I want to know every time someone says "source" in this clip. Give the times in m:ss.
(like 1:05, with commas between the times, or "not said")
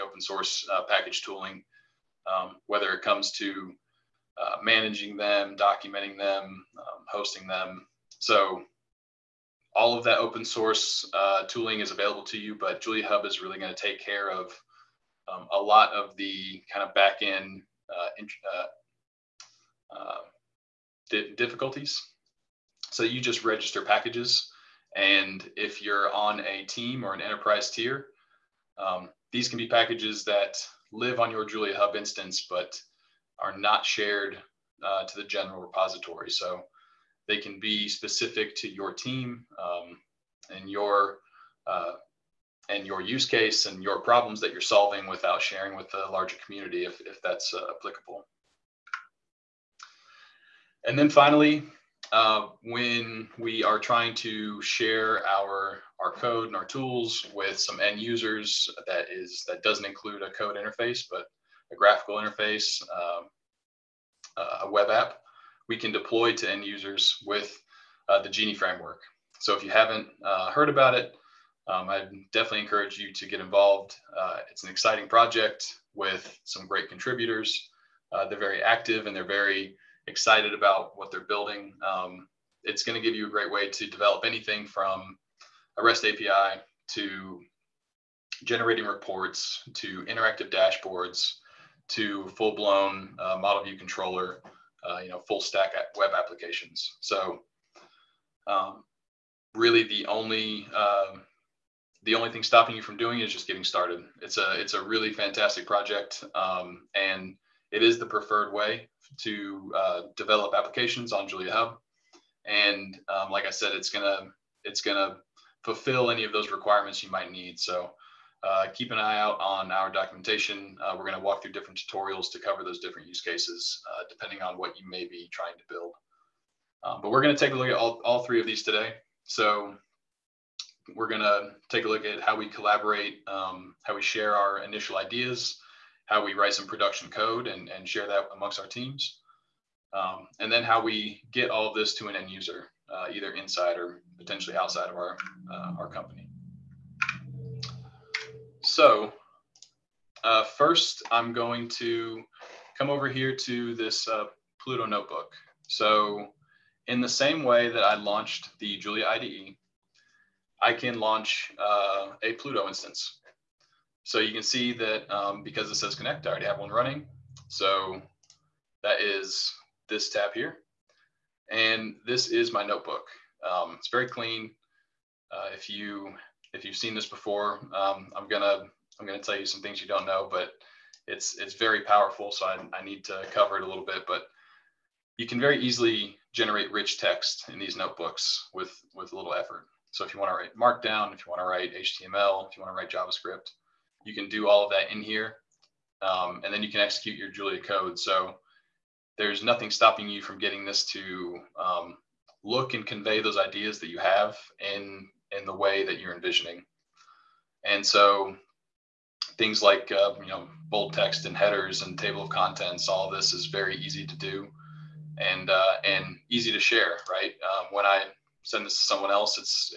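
0:00, 0:10.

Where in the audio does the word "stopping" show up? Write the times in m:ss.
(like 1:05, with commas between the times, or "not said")
1:42, 3:19.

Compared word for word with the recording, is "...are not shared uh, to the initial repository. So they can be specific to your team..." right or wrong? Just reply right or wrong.
wrong.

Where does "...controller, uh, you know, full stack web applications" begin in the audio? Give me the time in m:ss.
1:33.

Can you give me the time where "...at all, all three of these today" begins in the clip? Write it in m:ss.
2:07.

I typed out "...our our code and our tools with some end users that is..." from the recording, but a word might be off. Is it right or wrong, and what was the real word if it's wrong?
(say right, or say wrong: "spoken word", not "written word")
right.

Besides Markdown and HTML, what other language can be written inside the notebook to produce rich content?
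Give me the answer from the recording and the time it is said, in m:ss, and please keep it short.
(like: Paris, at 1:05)
JavaScript, at 3:12.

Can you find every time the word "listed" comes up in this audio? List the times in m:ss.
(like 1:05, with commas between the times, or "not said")
not said.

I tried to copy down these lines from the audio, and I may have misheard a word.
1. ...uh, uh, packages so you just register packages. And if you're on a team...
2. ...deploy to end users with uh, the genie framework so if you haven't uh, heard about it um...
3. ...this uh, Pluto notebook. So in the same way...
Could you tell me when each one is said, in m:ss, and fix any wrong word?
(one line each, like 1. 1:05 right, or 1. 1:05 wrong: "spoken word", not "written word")
1. 0:19 wrong: "difficulties", not "packages"
2. 1:05 right
3. 2:33 right.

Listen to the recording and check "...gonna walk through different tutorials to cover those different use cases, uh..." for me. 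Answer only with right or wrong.
right.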